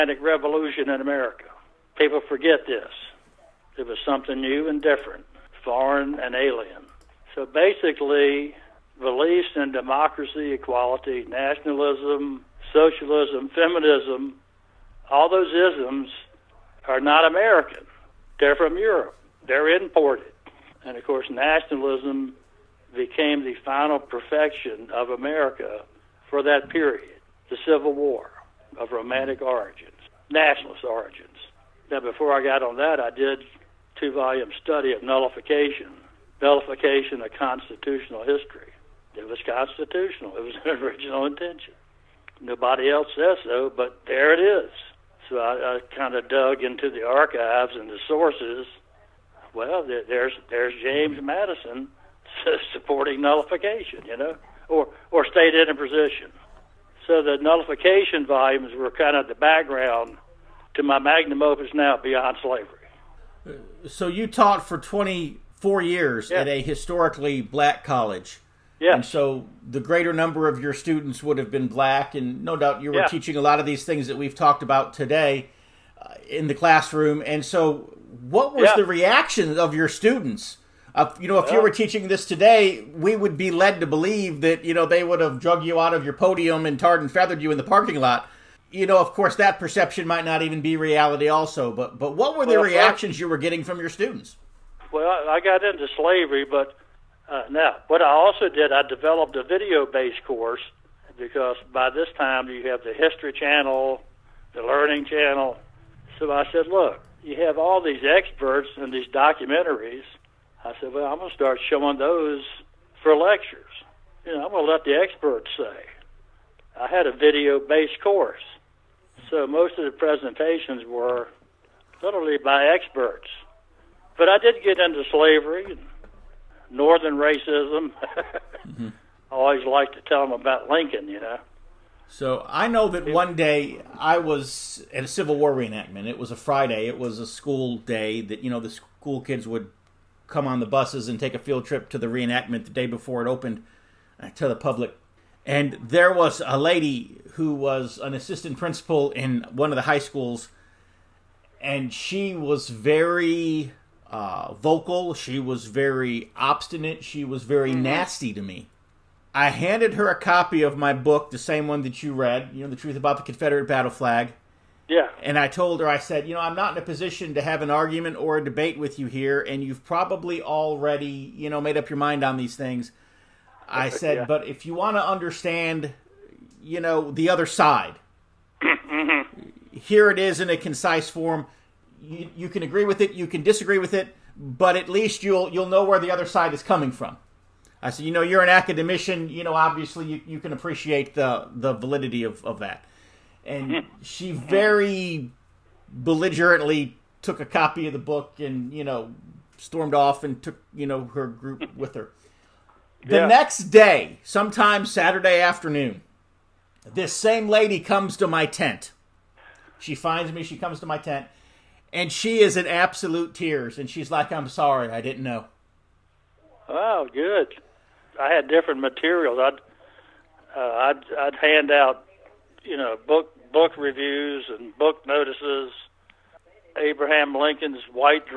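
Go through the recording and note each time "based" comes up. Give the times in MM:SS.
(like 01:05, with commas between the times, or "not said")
01:39, 01:57.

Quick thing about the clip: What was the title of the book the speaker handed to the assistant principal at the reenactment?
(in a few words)
The Truth About the Confederate Battle Flag.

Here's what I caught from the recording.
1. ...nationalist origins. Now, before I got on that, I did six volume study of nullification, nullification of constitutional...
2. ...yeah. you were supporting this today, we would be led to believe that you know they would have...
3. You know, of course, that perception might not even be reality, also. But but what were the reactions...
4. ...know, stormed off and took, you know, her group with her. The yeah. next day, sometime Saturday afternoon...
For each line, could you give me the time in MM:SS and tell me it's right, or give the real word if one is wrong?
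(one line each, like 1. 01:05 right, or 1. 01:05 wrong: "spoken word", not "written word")
1. 00:30 wrong: "two", not "six"
2. 01:21 wrong: "teaching", not "supporting"
3. 01:28 right
4. 03:18 right.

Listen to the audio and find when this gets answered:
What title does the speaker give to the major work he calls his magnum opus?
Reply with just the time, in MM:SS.
01:02.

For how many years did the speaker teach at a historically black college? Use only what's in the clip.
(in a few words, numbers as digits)
24.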